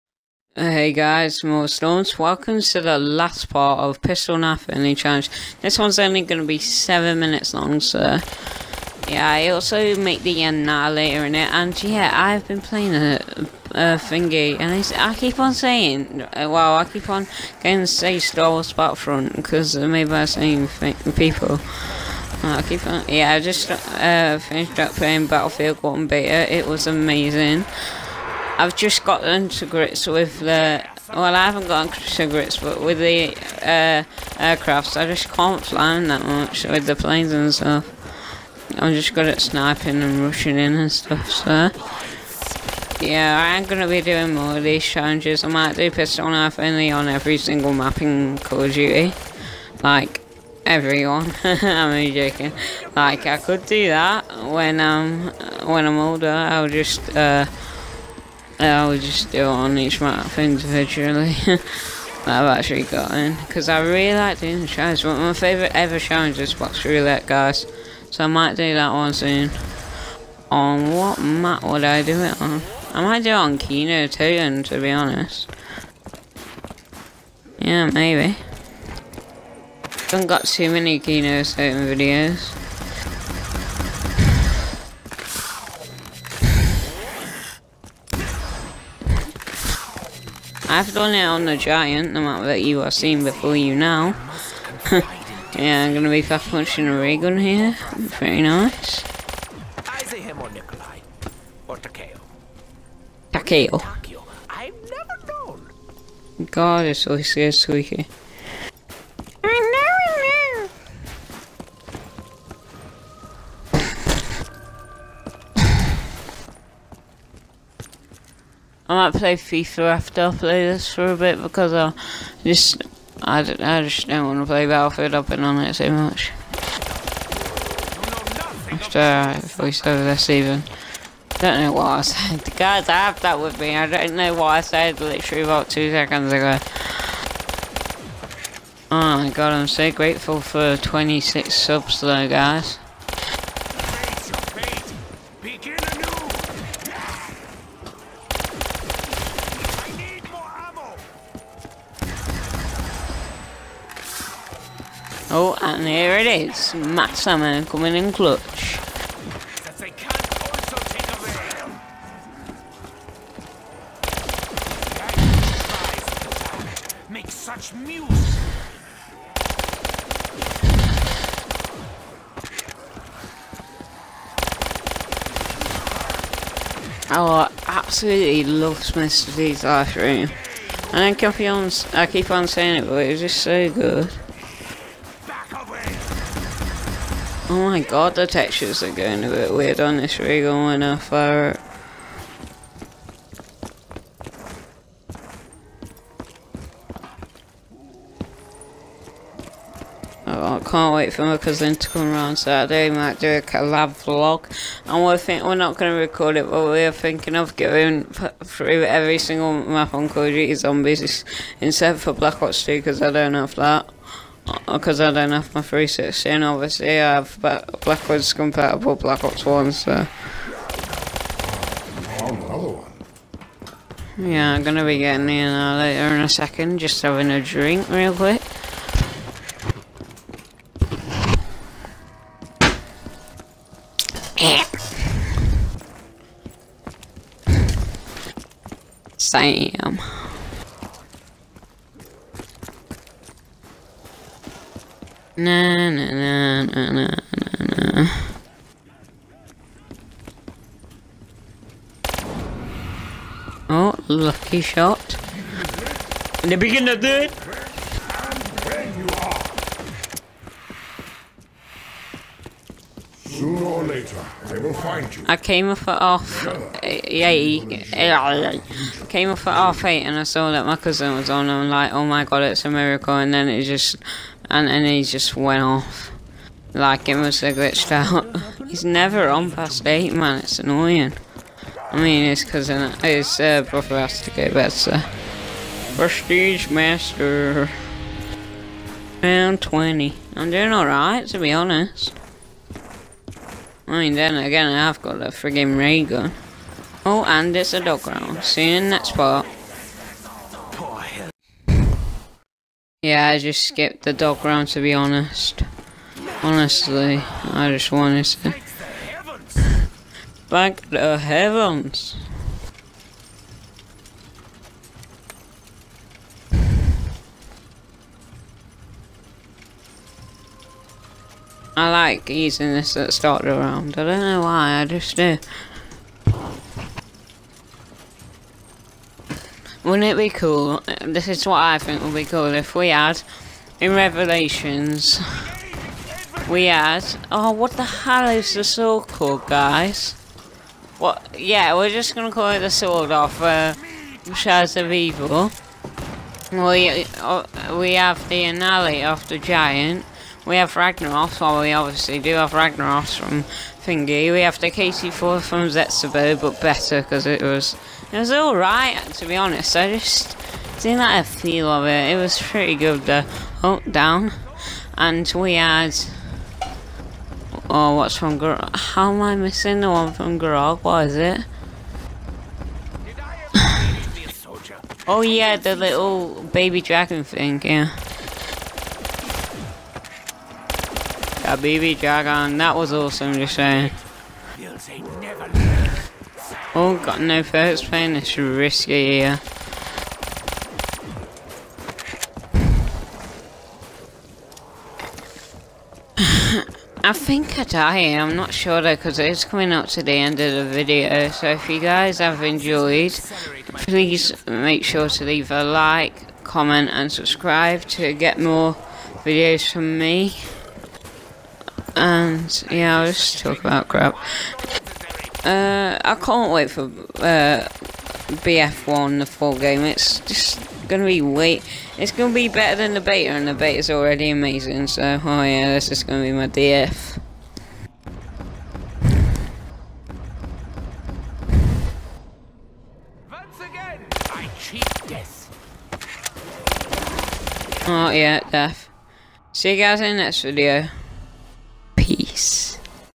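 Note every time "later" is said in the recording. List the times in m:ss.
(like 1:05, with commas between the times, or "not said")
0:10, 3:45, 4:23.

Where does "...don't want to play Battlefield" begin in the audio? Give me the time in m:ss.
2:04.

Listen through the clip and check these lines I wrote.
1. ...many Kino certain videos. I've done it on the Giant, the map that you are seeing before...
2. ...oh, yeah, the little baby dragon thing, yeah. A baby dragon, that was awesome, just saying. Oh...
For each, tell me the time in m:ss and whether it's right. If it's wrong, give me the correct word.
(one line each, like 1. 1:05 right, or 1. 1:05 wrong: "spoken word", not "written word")
1. 1:20 right
2. 6:15 right.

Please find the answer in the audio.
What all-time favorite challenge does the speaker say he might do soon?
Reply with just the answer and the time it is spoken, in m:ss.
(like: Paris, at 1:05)
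Box roulette, at 1:06.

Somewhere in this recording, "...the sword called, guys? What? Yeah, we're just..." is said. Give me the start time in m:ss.
5:38.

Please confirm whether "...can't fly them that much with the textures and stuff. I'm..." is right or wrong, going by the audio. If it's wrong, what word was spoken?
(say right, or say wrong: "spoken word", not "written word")
wrong: "planes", not "textures".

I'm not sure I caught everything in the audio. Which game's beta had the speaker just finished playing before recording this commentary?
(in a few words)
Battlefield 1.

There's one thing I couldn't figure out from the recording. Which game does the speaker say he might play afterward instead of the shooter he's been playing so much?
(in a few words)
FIFA.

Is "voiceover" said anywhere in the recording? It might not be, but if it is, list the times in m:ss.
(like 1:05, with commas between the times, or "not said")
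2:09.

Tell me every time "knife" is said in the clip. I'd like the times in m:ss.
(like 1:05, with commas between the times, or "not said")
0:04, 0:46.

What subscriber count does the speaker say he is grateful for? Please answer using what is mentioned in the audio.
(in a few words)
26.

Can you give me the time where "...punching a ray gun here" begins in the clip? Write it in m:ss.
1:36.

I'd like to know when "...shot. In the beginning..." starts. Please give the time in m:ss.
4:14.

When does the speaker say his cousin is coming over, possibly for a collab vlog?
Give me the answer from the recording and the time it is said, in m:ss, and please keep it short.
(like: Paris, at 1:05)
Saturday, at 3:22.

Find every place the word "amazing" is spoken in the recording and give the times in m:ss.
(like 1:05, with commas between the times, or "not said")
0:26, 7:04.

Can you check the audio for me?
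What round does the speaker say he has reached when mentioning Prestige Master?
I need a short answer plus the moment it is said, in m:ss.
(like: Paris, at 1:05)
20, at 4:49.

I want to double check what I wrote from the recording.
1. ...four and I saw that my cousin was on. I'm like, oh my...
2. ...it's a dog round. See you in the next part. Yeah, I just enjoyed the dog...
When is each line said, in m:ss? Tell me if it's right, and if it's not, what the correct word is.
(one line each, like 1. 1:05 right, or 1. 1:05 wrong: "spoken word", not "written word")
1. 4:29 wrong: "eight", not "four"
2. 4:57 wrong: "skipped", not "enjoyed".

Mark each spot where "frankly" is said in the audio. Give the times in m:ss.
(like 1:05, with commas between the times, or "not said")
not said.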